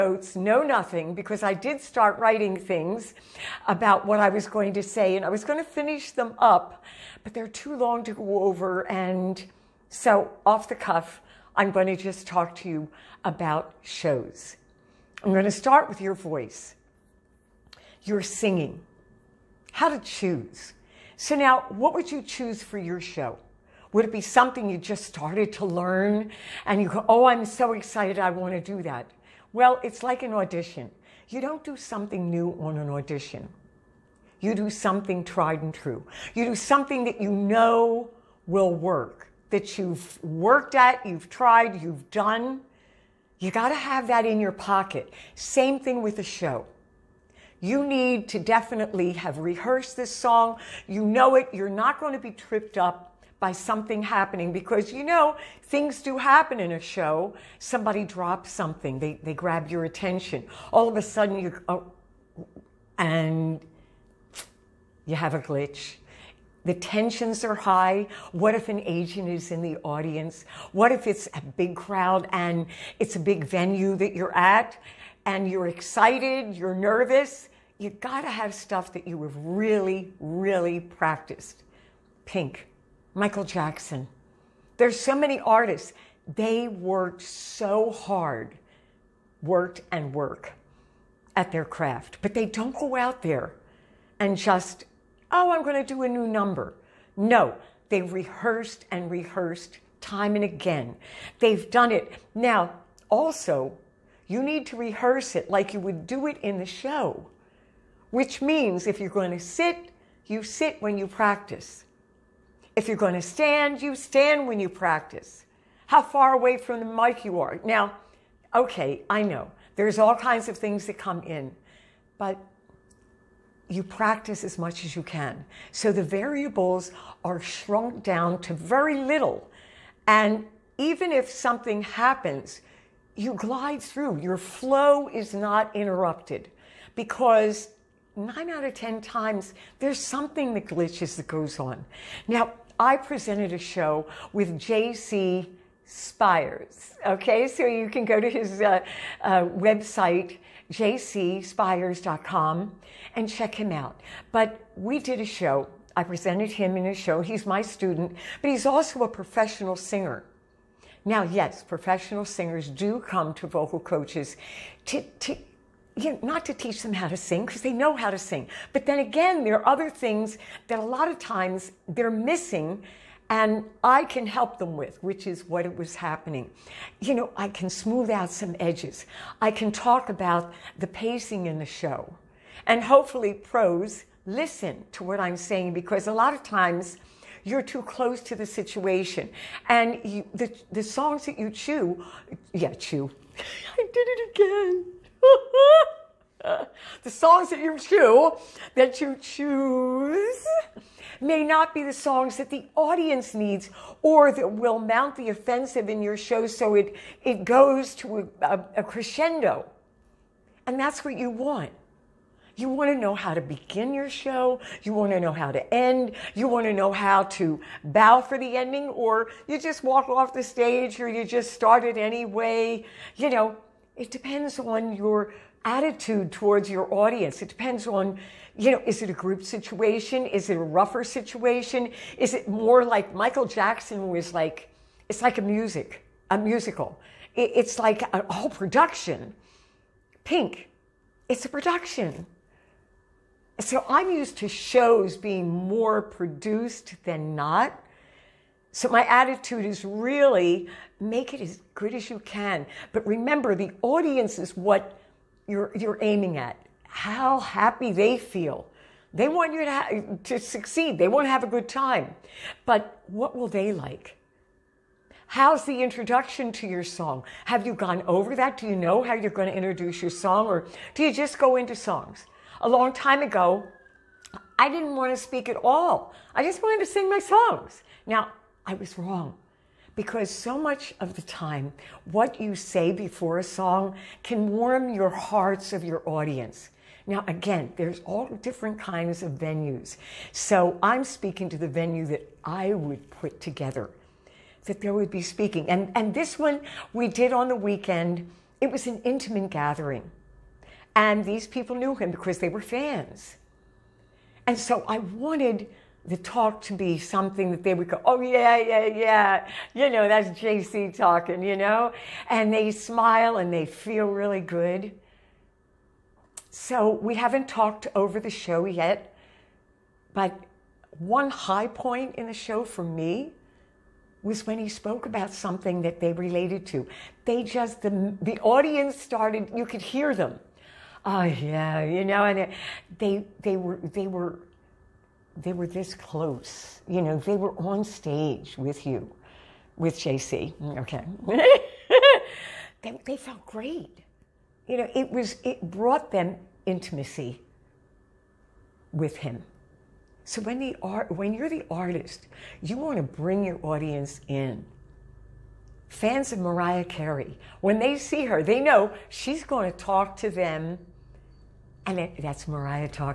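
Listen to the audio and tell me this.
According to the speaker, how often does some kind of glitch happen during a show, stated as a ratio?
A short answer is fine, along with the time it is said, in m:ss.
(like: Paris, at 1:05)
9 out of 10 times, at 2:18.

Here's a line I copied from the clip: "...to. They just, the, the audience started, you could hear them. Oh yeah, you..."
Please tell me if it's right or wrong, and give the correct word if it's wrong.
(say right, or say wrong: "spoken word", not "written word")
right.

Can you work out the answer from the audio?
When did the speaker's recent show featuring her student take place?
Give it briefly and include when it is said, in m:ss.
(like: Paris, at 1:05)
On the weekend, at 4:57.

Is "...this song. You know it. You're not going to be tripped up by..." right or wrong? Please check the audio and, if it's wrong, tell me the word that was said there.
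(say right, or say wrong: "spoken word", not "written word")
right.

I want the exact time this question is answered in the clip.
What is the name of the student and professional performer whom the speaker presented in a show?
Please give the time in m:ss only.
2:24.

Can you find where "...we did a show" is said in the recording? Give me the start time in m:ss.
2:34.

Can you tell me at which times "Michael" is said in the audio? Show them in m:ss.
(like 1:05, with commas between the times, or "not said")
1:23, 3:53.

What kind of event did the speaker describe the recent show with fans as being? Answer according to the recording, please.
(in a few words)
An intimate gathering.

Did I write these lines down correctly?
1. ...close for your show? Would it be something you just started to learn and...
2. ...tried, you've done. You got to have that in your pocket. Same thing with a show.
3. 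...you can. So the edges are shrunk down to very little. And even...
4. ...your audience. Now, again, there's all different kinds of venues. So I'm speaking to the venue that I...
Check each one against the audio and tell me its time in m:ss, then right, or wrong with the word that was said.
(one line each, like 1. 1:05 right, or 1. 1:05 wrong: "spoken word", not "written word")
1. 0:22 wrong: "choose", not "close"
2. 0:41 right
3. 2:04 wrong: "variables", not "edges"
4. 4:45 right.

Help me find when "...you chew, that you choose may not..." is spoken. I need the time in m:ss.
3:17.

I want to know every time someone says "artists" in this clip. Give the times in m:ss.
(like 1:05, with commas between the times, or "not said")
1:25, 5:51.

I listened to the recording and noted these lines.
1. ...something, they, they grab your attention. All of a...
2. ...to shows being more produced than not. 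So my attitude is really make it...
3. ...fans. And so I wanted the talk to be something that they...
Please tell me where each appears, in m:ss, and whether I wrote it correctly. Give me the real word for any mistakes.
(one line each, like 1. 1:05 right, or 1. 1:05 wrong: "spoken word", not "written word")
1. 0:58 right
2. 4:04 right
3. 5:02 right.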